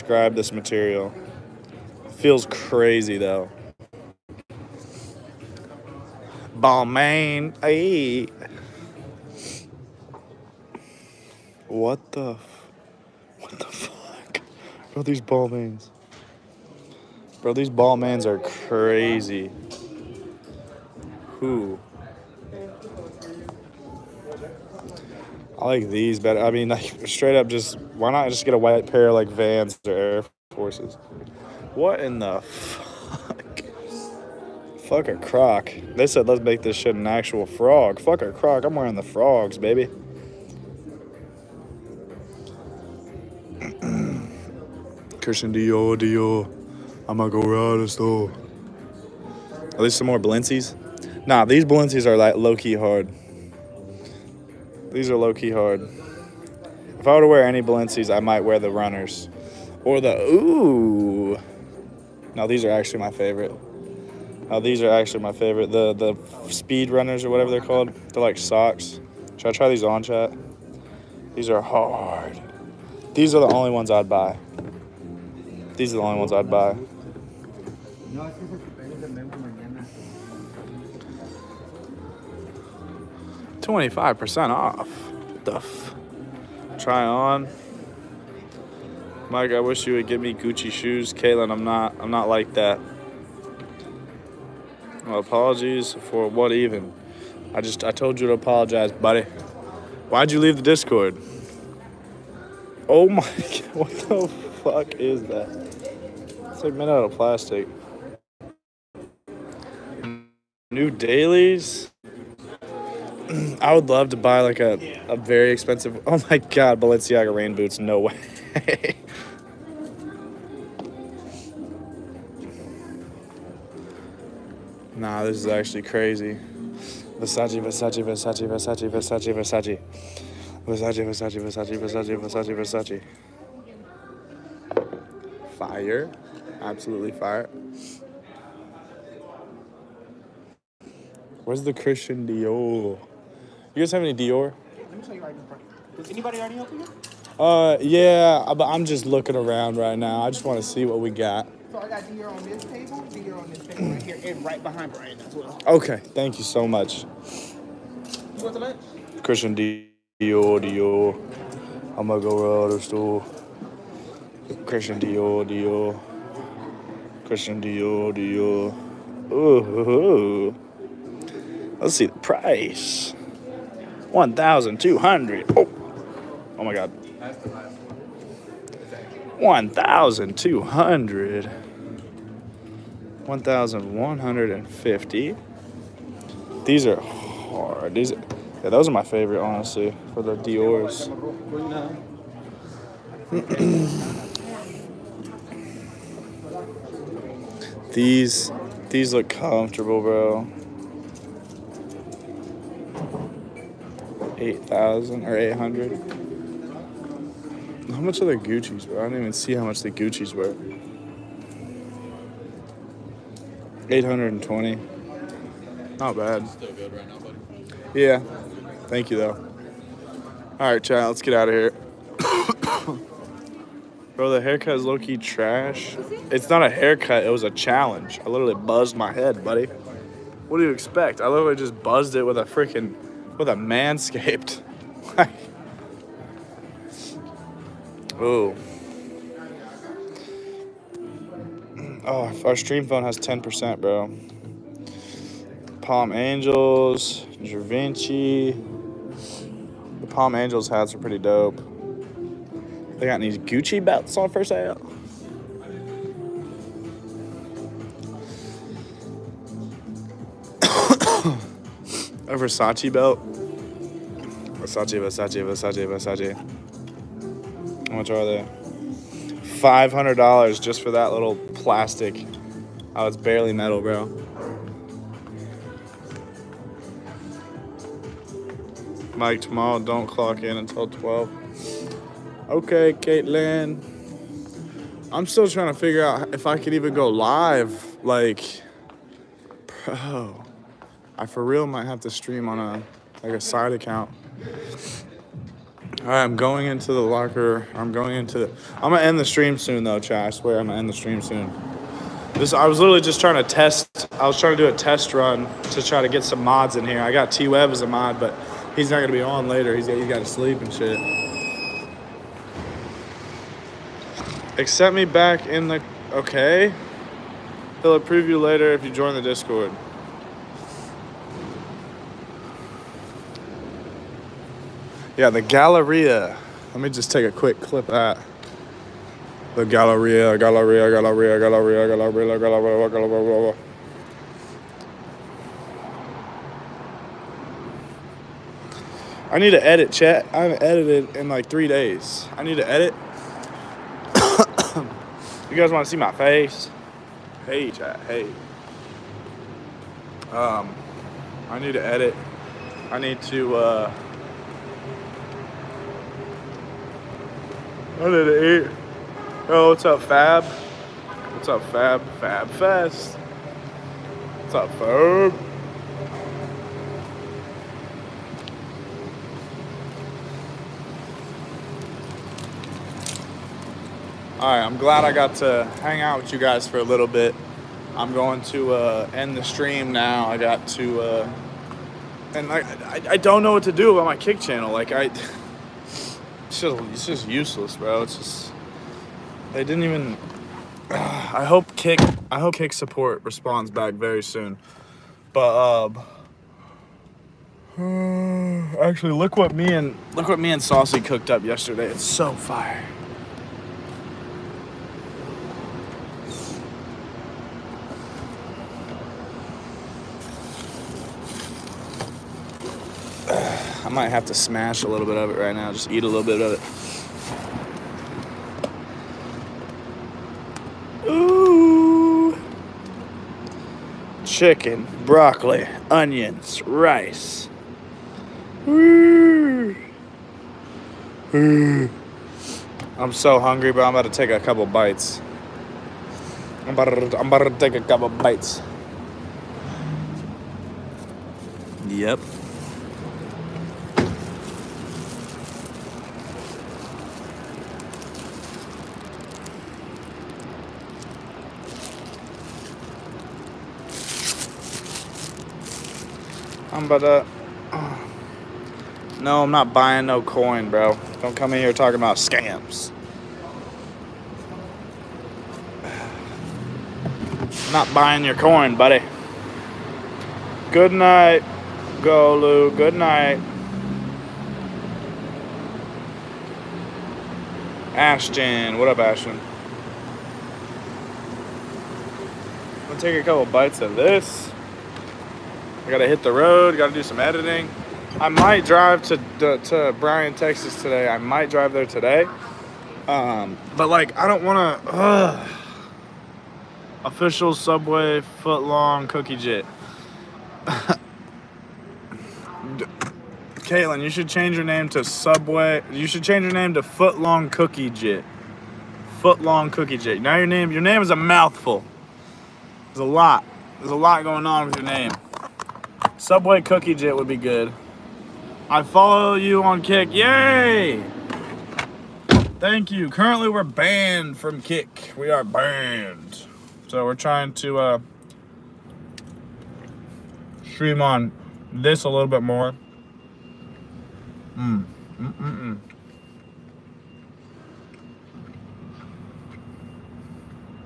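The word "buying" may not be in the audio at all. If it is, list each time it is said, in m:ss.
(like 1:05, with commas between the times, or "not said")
7:39, 7:47.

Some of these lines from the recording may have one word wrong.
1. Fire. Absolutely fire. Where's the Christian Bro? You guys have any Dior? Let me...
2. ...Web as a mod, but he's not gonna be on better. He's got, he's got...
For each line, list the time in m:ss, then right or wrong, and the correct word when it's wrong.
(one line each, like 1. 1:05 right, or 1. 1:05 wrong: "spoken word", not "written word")
1. 2:15 wrong: "Dior", not "Bro"
2. 5:07 wrong: "later", not "better".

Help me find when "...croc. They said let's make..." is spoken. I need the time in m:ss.
0:35.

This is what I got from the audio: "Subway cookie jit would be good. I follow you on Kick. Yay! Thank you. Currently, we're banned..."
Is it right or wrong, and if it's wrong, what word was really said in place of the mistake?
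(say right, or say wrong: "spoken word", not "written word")
right.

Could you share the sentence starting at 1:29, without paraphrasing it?
Mike, I wish you would give me Gucci shoes.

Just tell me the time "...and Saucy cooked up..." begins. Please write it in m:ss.
6:40.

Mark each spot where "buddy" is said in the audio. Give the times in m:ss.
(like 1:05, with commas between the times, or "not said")
1:38, 3:37, 3:49, 7:48.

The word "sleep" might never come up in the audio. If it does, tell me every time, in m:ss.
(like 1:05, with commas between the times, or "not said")
5:10.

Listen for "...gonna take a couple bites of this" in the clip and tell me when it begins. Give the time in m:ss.
8:02.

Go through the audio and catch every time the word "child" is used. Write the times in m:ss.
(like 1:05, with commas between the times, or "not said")
3:40.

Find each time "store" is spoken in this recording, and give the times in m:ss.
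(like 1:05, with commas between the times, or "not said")
0:47, 2:42.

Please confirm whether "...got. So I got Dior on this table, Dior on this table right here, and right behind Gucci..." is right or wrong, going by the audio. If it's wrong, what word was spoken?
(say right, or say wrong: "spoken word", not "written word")
wrong: "Brian", not "Gucci".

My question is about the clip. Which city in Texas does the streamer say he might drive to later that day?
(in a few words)
Bryan, Texas.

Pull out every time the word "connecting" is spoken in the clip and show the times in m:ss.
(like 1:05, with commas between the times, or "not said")
not said.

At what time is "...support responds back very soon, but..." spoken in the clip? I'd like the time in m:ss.
6:32.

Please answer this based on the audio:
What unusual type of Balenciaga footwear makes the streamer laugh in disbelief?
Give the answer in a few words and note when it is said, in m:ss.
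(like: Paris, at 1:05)
Rain boots, at 1:56.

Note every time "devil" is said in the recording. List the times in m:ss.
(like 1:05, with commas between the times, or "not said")
not said.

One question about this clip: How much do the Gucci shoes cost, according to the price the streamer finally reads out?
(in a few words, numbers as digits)
820.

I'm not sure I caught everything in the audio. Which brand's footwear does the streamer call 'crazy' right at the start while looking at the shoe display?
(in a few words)
Balmain.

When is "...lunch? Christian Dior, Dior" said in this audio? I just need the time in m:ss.
2:38.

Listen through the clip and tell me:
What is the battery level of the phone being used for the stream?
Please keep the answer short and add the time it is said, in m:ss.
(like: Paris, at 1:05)
10%, at 4:03.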